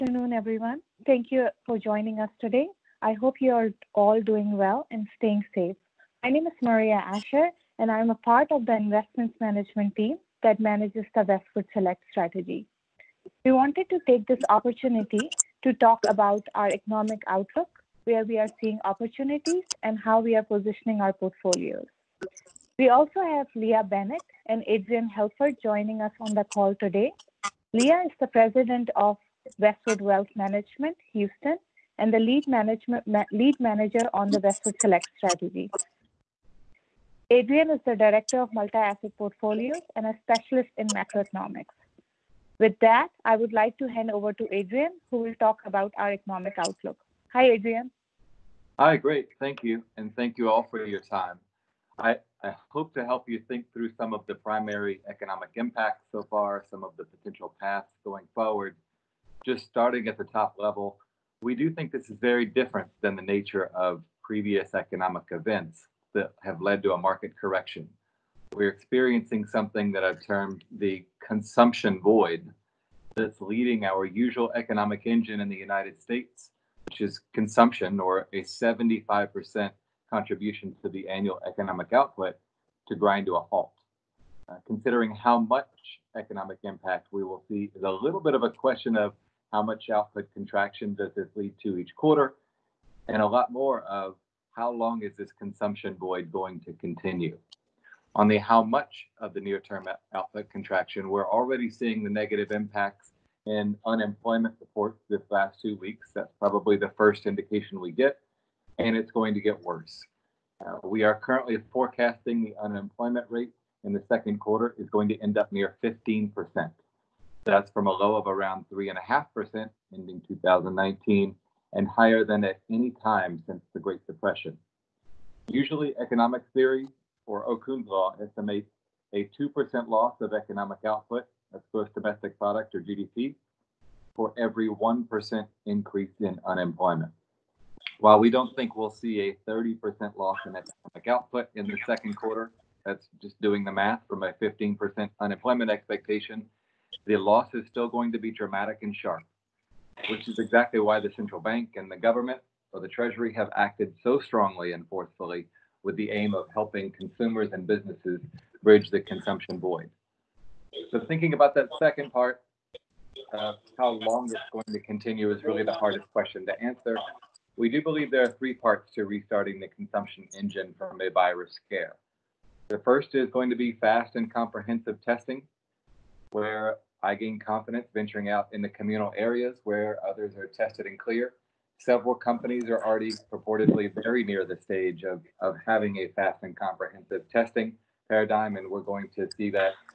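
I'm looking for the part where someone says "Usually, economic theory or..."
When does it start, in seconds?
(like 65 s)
125 s.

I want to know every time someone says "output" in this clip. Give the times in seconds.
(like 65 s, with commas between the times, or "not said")
81 s, 89 s, 100 s, 130 s, 141 s.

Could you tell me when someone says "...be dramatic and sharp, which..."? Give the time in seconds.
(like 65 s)
148 s.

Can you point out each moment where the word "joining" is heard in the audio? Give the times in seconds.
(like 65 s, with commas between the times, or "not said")
1 s, 25 s.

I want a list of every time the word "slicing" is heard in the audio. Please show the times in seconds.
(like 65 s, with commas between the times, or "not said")
not said.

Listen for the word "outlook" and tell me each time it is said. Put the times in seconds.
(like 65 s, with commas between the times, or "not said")
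17 s, 46 s.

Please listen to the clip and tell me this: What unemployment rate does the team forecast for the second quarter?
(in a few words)
15%.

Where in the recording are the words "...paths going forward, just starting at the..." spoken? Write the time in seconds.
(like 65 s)
57 s.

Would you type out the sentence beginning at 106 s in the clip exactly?
That's probably the first indication we get, and it's going to get worse.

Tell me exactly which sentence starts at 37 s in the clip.
Adrian is the director of multi asset portfolios and a specialist in macroeconomics.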